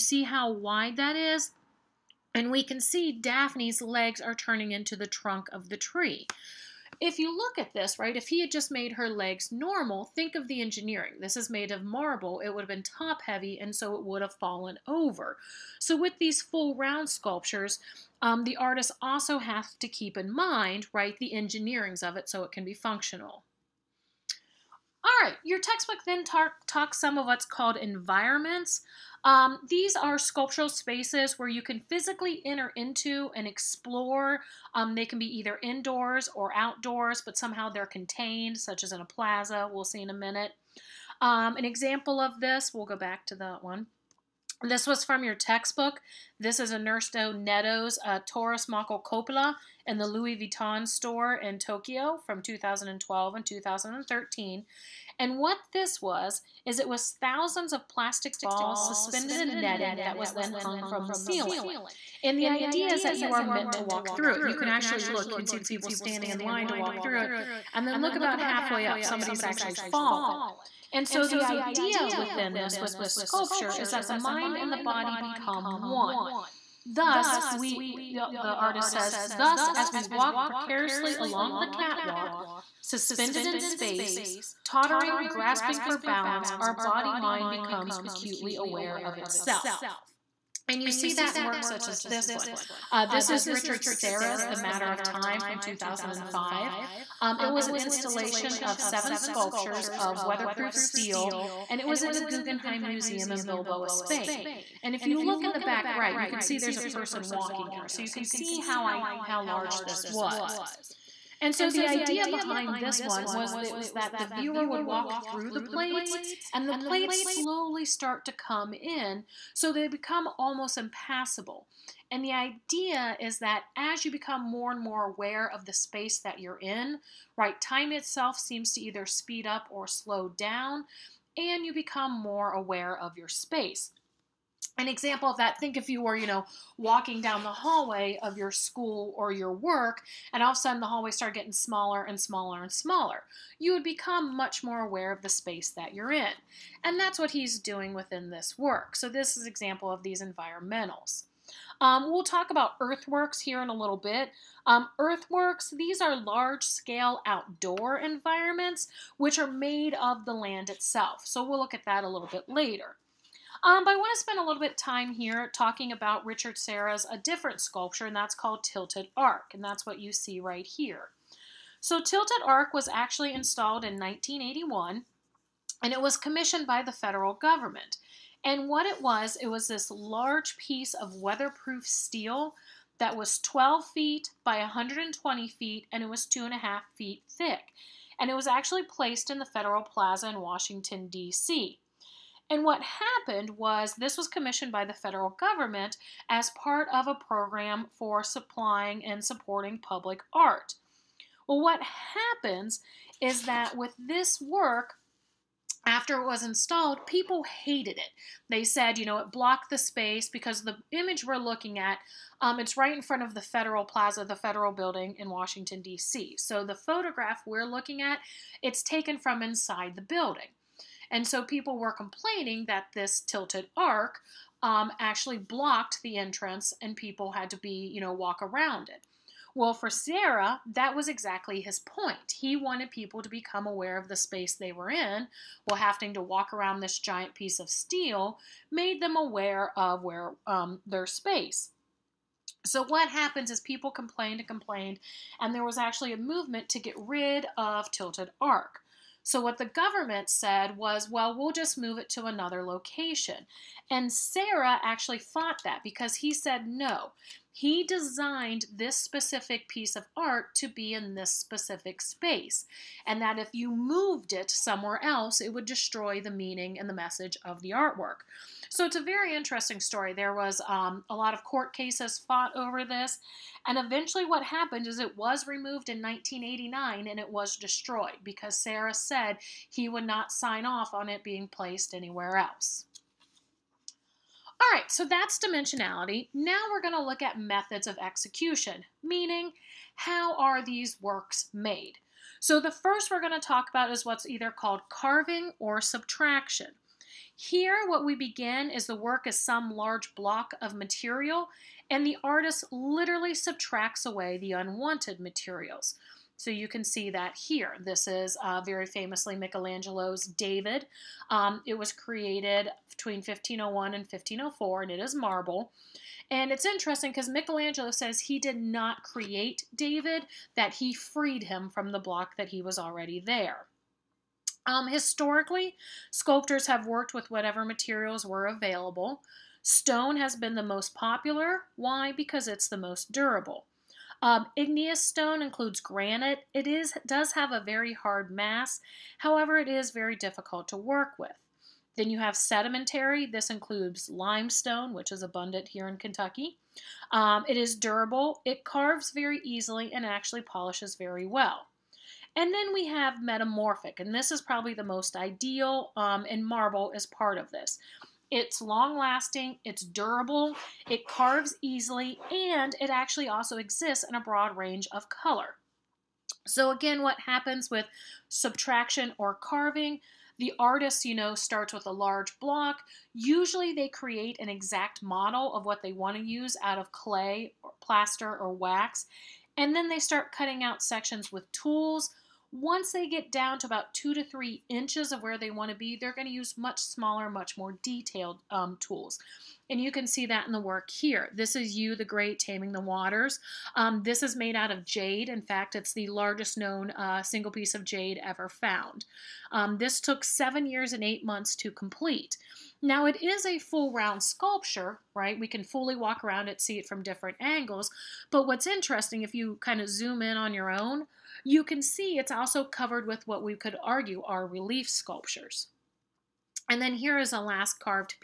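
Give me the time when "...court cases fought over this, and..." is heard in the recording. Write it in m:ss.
4:31.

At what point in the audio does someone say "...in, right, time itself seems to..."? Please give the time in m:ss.
2:06.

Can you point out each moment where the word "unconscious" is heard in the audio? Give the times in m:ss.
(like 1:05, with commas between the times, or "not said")
not said.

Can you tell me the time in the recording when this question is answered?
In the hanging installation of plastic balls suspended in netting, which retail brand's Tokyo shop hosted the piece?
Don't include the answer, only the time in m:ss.
0:50.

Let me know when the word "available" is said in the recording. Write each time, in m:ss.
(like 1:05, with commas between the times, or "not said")
5:28.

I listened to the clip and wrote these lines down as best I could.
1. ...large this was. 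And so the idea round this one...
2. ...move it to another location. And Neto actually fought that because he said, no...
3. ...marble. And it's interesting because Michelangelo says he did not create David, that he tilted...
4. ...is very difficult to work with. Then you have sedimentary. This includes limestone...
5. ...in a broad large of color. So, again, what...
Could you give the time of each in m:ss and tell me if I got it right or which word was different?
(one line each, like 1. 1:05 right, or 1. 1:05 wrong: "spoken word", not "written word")
1. 1:49 wrong: "behind", not "round"
2. 4:11 wrong: "Serra", not "Neto"
3. 5:15 wrong: "freed", not "tilted"
4. 5:39 right
5. 6:04 wrong: "range", not "large".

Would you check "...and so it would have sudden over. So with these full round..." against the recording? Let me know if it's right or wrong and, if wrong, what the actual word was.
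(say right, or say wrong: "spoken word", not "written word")
wrong: "fallen", not "sudden".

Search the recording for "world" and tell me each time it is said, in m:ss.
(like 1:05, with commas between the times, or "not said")
not said.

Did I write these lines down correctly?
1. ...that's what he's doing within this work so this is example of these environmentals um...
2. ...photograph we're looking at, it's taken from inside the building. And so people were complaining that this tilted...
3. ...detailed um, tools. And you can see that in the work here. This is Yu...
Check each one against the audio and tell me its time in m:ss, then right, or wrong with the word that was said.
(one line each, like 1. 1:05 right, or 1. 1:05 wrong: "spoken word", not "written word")
1. 2:26 right
2. 3:36 right
3. 6:27 right.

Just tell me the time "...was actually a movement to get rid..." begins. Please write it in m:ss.
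4:05.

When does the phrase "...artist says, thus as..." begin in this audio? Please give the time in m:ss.
1:18.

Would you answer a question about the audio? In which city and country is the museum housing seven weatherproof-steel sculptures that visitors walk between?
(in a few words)
Bilbao, Spain.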